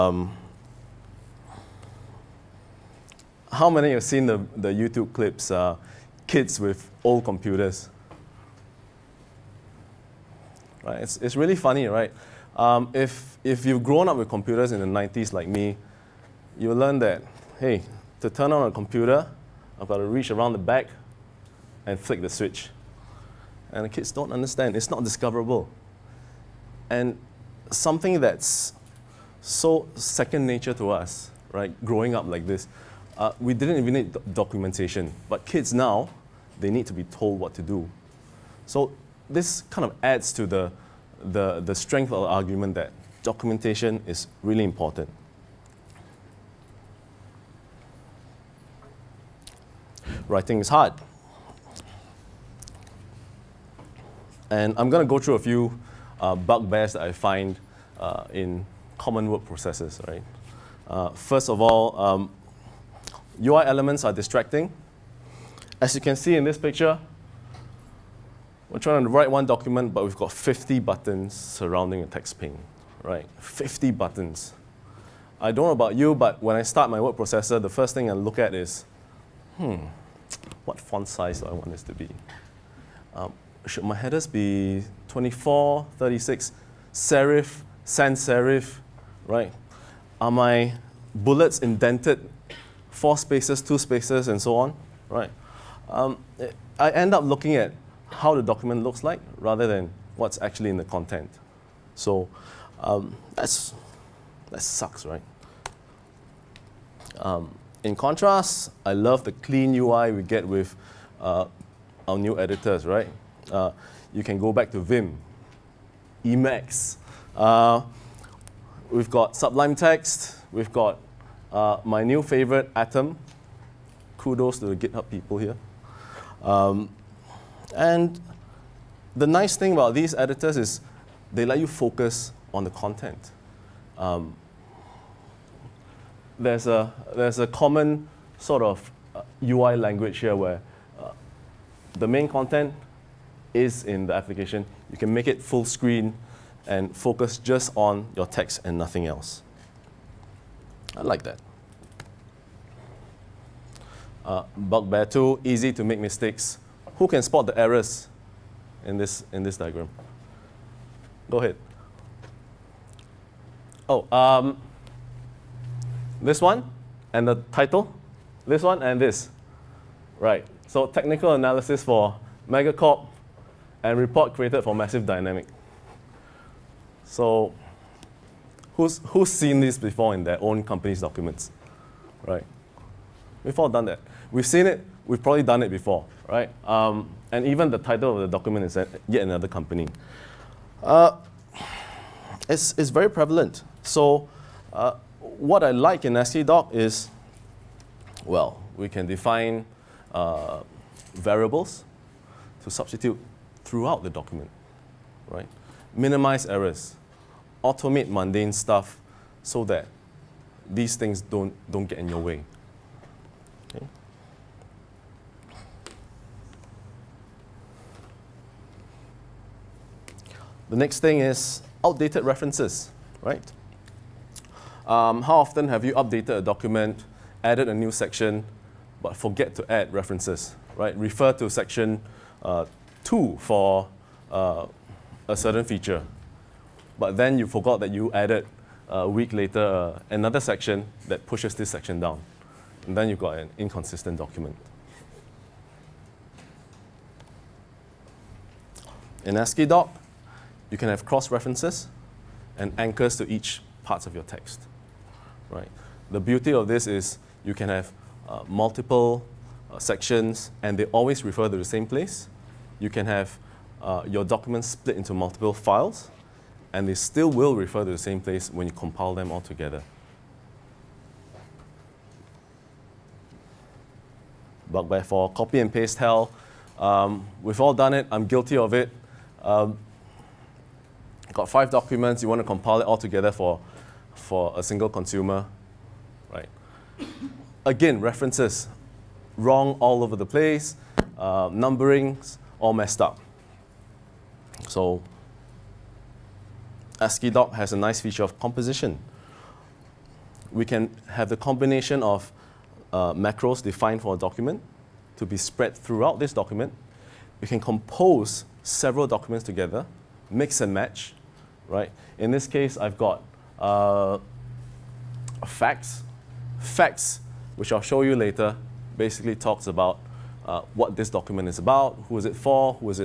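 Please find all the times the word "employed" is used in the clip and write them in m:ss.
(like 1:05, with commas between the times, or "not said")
not said.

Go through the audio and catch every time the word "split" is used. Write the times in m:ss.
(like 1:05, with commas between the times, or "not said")
4:24.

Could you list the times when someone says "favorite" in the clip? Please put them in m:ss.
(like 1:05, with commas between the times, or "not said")
2:02.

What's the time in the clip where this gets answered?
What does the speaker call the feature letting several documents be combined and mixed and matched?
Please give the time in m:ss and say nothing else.
4:58.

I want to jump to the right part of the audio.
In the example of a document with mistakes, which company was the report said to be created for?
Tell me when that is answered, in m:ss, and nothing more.
2:54.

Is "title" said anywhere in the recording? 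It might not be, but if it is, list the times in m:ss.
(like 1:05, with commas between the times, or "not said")
2:47, 3:07.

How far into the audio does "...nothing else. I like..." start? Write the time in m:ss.
2:28.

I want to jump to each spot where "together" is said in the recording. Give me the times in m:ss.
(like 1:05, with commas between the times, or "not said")
4:29, 4:42, 5:09.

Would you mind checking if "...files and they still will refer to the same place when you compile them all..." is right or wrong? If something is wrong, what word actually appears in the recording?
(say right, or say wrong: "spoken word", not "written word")
right.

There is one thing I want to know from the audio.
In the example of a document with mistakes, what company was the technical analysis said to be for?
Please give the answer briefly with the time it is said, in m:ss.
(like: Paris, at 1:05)
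Megacorp, at 2:52.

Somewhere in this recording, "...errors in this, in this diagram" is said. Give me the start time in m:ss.
2:37.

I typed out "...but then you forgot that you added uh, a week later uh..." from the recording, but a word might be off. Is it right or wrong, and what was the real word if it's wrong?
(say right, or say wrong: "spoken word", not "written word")
right.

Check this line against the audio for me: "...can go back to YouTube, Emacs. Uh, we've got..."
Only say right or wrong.
wrong.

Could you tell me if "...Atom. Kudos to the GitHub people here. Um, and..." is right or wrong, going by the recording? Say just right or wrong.
right.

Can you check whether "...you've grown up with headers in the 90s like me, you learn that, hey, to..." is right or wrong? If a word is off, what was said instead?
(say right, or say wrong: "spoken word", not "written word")
wrong: "computers", not "headers".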